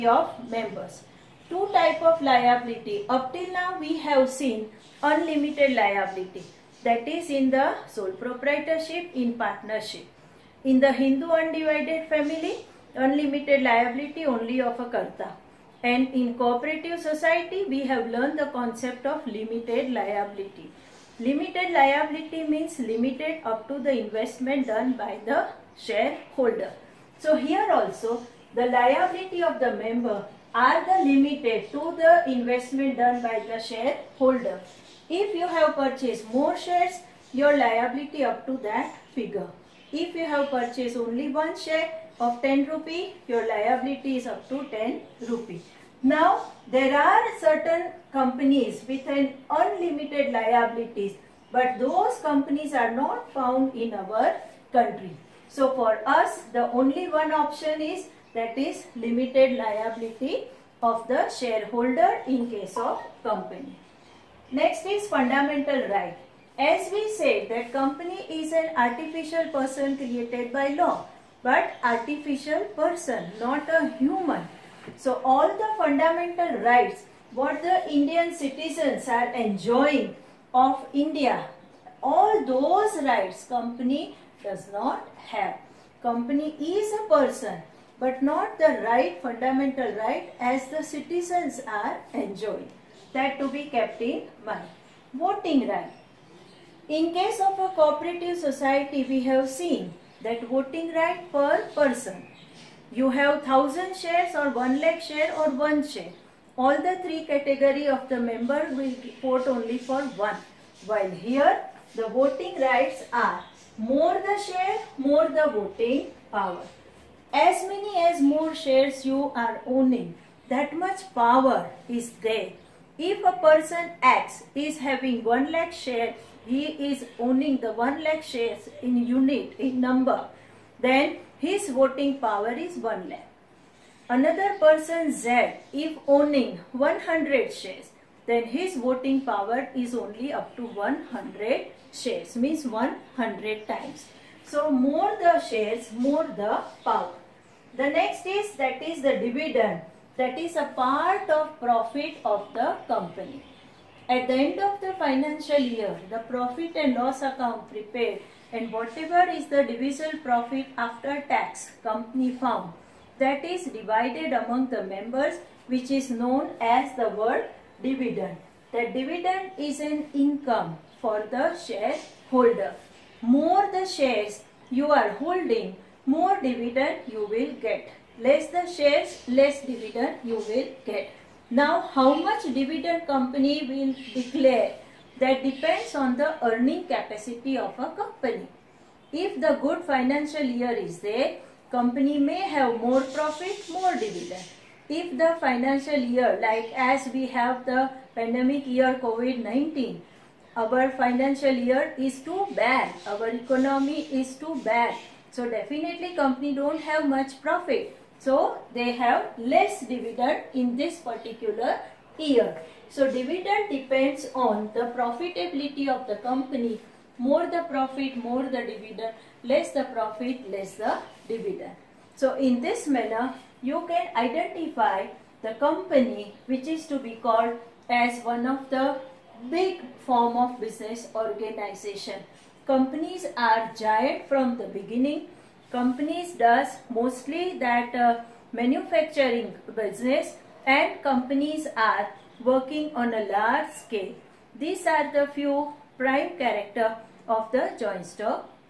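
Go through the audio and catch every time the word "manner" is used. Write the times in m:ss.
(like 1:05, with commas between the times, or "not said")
3:42.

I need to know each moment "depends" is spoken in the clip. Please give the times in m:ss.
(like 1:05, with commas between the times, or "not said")
3:05, 3:33.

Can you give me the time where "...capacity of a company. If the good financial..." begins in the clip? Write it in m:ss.
3:06.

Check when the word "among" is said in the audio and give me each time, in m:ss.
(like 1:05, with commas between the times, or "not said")
2:44.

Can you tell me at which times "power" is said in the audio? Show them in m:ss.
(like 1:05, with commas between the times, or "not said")
1:56, 2:01, 2:12, 2:19, 2:26.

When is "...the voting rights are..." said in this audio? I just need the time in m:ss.
1:51.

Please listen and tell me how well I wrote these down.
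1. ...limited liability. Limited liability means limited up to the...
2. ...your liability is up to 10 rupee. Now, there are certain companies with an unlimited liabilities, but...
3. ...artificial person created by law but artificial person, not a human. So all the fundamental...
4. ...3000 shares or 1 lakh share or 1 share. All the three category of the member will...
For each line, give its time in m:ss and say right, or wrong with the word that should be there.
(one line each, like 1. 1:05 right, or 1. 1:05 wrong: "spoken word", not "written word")
1. 0:19 right
2. 0:43 right
3. 1:08 right
4. 1:43 wrong: "1000", not "3000".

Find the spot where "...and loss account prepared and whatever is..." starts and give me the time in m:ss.
2:36.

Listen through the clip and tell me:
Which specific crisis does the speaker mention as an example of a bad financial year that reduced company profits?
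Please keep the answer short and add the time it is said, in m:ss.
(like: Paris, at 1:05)
COVID-19, at 3:18.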